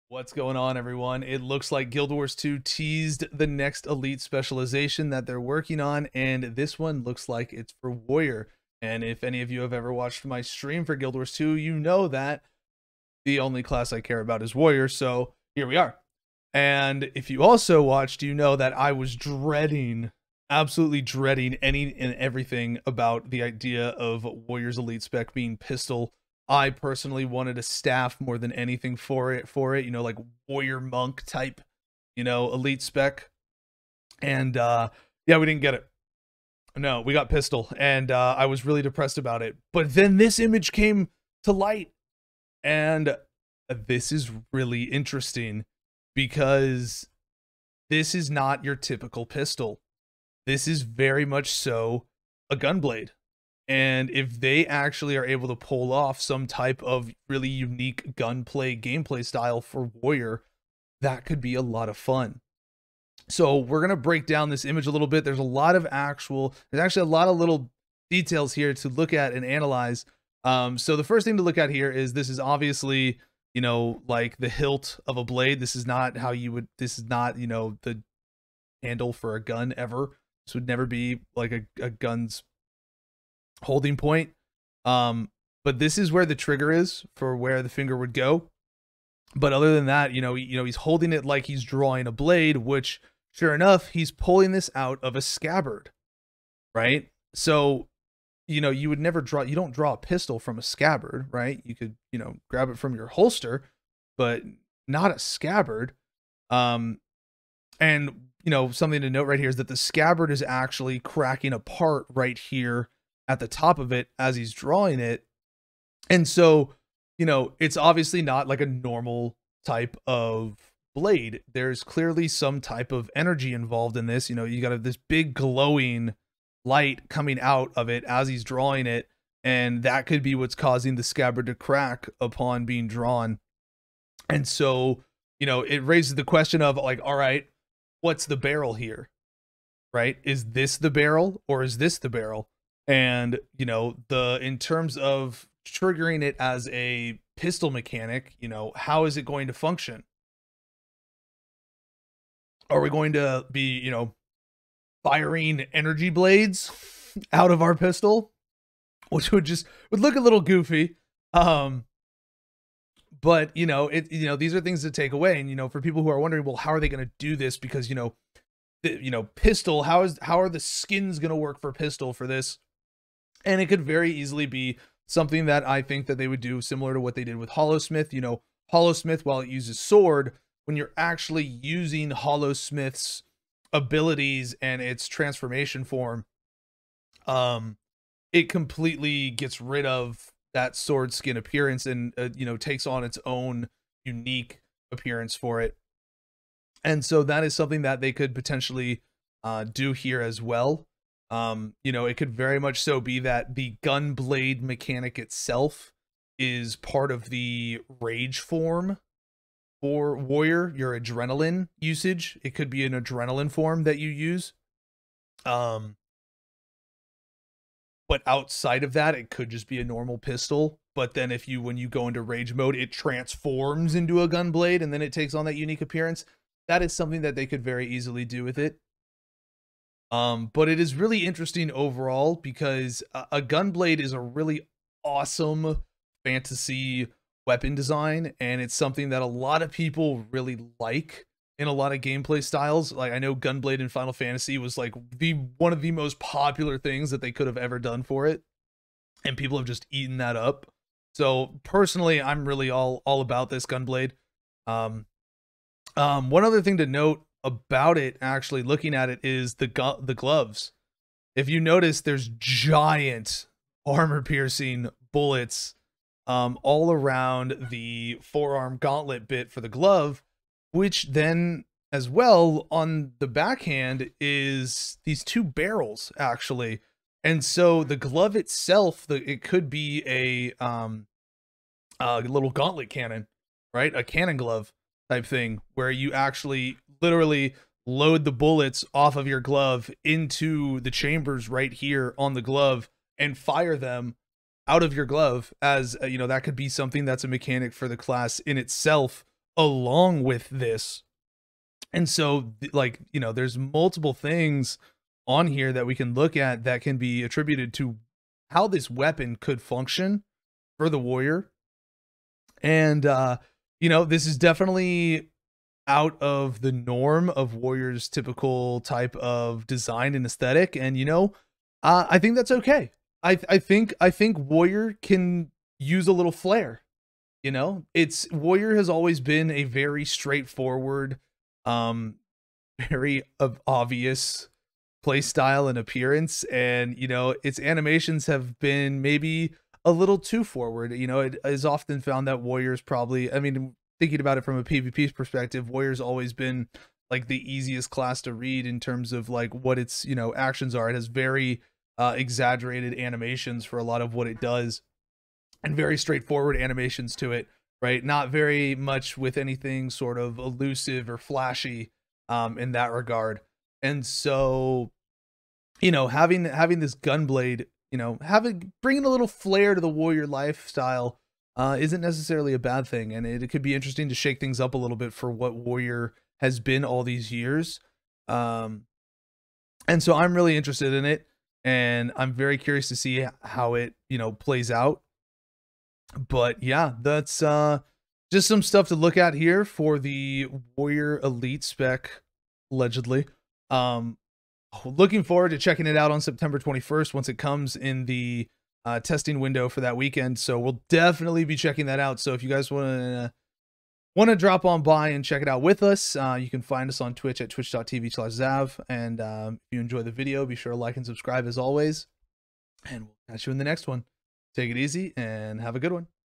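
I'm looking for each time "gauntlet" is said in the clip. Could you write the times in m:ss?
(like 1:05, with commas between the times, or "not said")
4:28, 4:42.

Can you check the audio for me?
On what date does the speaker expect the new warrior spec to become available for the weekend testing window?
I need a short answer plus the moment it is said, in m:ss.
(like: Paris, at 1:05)
September 21, at 6:36.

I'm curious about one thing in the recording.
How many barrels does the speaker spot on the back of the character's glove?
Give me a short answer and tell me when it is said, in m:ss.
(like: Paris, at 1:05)
2, at 4:35.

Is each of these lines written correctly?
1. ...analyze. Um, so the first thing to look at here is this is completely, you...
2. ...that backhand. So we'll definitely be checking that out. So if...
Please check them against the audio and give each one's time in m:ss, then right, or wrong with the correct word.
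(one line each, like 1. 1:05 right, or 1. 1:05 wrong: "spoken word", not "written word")
1. 1:09 wrong: "obviously", not "completely"
2. 6:39 wrong: "weekend", not "backhand".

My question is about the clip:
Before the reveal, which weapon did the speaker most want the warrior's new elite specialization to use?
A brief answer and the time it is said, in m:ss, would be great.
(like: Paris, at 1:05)
Staff, at 0:27.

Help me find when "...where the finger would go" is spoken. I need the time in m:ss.
1:27.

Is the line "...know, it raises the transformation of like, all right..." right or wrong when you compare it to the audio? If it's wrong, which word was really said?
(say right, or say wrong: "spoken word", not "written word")
wrong: "question", not "transformation".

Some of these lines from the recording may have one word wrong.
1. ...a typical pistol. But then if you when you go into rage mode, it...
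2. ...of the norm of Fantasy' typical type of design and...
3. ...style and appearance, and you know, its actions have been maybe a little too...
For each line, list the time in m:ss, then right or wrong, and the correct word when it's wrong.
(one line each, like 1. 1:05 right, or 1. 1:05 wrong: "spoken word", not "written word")
1. 3:39 wrong: "normal", not "typical"
2. 5:16 wrong: "Warriors", not "Fantasy"
3. 5:35 wrong: "animations", not "actions".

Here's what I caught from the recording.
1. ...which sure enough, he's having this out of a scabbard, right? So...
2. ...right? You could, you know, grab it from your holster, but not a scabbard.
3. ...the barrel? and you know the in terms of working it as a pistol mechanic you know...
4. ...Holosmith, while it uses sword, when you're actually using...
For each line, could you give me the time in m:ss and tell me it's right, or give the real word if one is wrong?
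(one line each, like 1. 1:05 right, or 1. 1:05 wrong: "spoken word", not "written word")
1. 1:32 wrong: "pulling", not "having"
2. 1:41 right
3. 2:21 wrong: "triggering", not "working"
4. 2:58 right.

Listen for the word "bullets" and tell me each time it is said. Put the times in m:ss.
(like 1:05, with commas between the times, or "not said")
4:25, 4:48.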